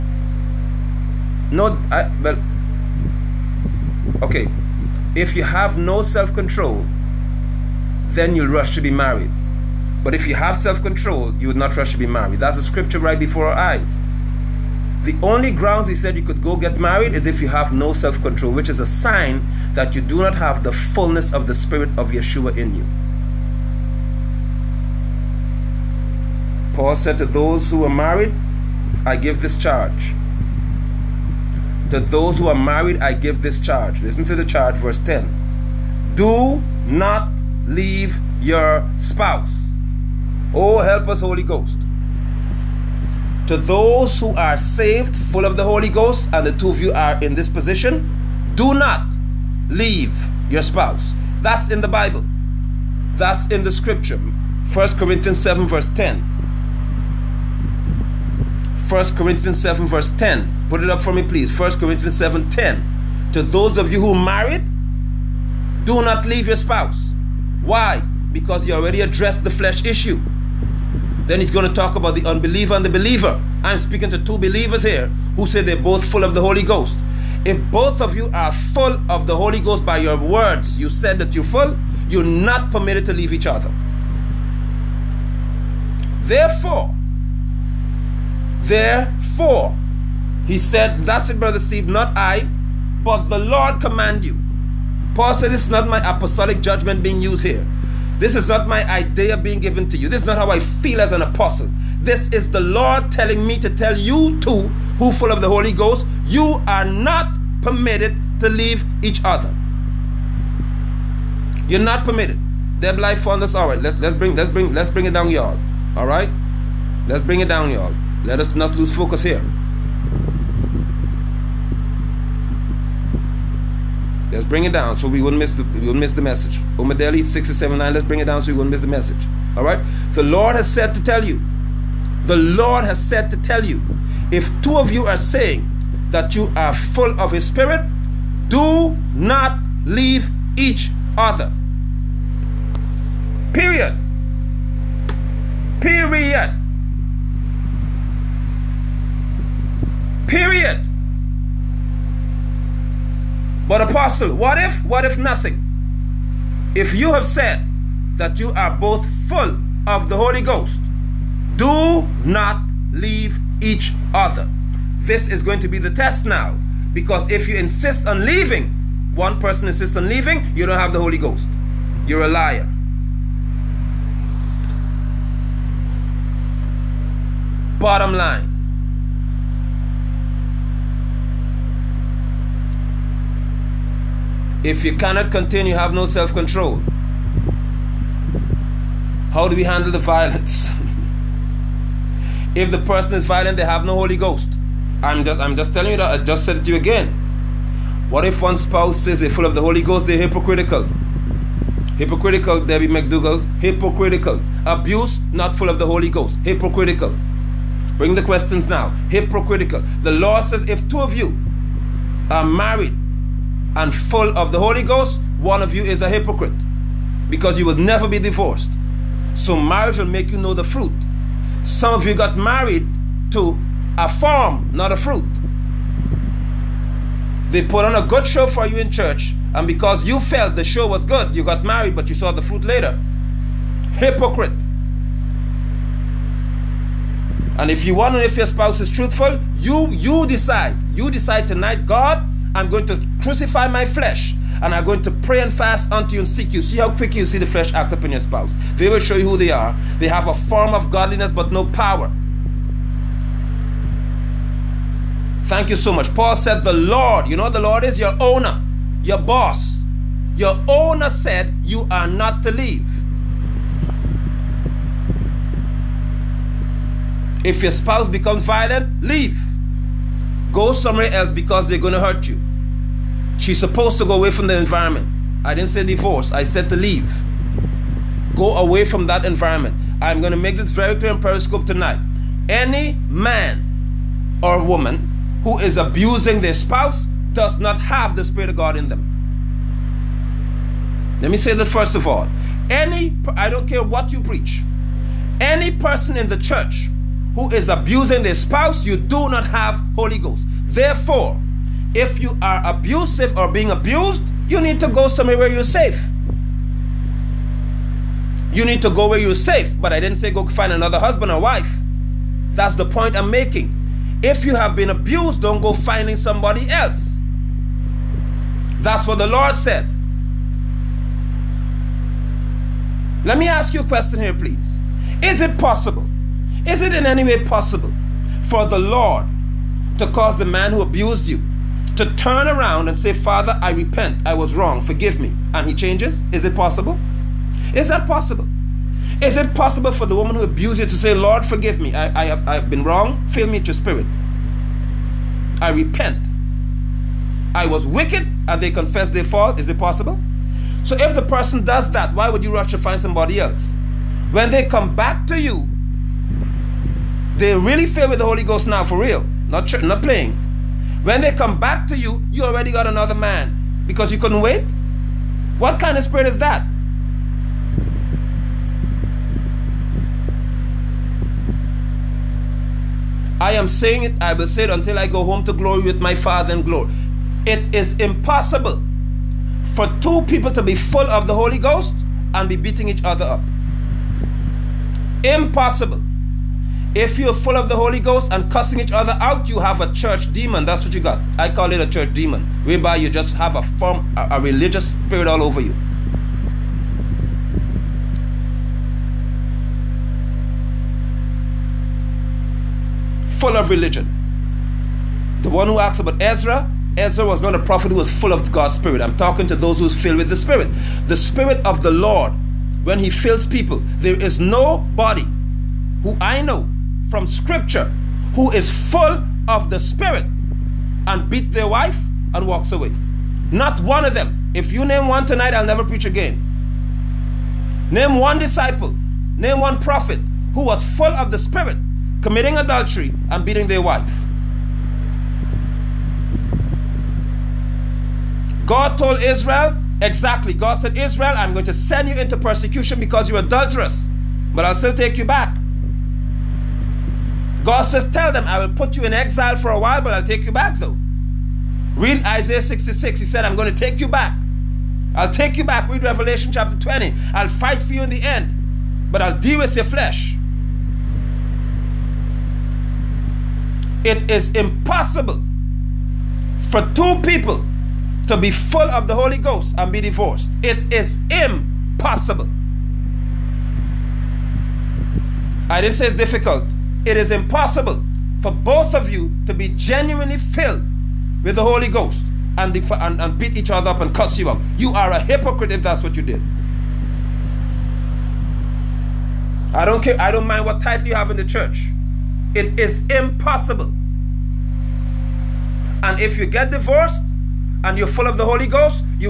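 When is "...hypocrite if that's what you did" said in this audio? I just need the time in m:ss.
8:05.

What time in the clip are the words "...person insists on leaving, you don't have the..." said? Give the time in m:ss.
2:49.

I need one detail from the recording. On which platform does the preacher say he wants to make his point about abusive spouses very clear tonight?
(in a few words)
Periscope.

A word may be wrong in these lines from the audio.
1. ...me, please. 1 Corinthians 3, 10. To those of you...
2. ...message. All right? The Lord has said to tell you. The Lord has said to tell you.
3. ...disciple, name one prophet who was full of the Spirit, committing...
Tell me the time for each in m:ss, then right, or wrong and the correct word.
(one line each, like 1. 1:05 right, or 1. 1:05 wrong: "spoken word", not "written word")
1. 1:01 wrong: "7", not "3"
2. 2:08 right
3. 7:08 right.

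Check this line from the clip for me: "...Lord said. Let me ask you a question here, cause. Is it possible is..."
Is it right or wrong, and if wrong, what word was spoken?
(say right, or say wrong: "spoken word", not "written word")
wrong: "please", not "cause".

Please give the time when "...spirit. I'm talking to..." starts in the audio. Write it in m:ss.
6:48.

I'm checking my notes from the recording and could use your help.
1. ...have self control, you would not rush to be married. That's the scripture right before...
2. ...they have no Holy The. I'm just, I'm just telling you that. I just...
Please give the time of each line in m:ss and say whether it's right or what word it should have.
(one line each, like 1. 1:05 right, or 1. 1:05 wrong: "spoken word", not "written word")
1. 0:10 right
2. 3:13 wrong: "Ghost", not "The".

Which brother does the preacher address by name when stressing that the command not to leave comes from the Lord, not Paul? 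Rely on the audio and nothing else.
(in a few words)
Brother Steve.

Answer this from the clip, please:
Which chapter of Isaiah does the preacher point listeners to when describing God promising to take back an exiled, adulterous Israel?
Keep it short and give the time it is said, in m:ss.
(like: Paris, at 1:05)
Isaiah 66, at 7:32.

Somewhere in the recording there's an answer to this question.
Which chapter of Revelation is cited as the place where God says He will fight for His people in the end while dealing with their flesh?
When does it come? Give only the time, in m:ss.
7:36.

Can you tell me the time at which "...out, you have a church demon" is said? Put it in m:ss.
6:29.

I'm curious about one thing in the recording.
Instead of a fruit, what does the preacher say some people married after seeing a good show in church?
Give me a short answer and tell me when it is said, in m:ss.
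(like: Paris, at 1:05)
a farm, at 3:43.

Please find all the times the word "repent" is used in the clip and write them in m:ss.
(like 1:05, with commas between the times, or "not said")
5:33, 5:45.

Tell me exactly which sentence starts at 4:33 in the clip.
She's supposed to go away from the environment.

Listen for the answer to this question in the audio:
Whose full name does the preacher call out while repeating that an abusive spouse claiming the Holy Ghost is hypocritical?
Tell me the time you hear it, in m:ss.
3:22.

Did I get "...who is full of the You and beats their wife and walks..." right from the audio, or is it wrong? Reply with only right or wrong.
wrong.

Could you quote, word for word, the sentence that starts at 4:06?
See how quickly you see the flesh act up in your spouse.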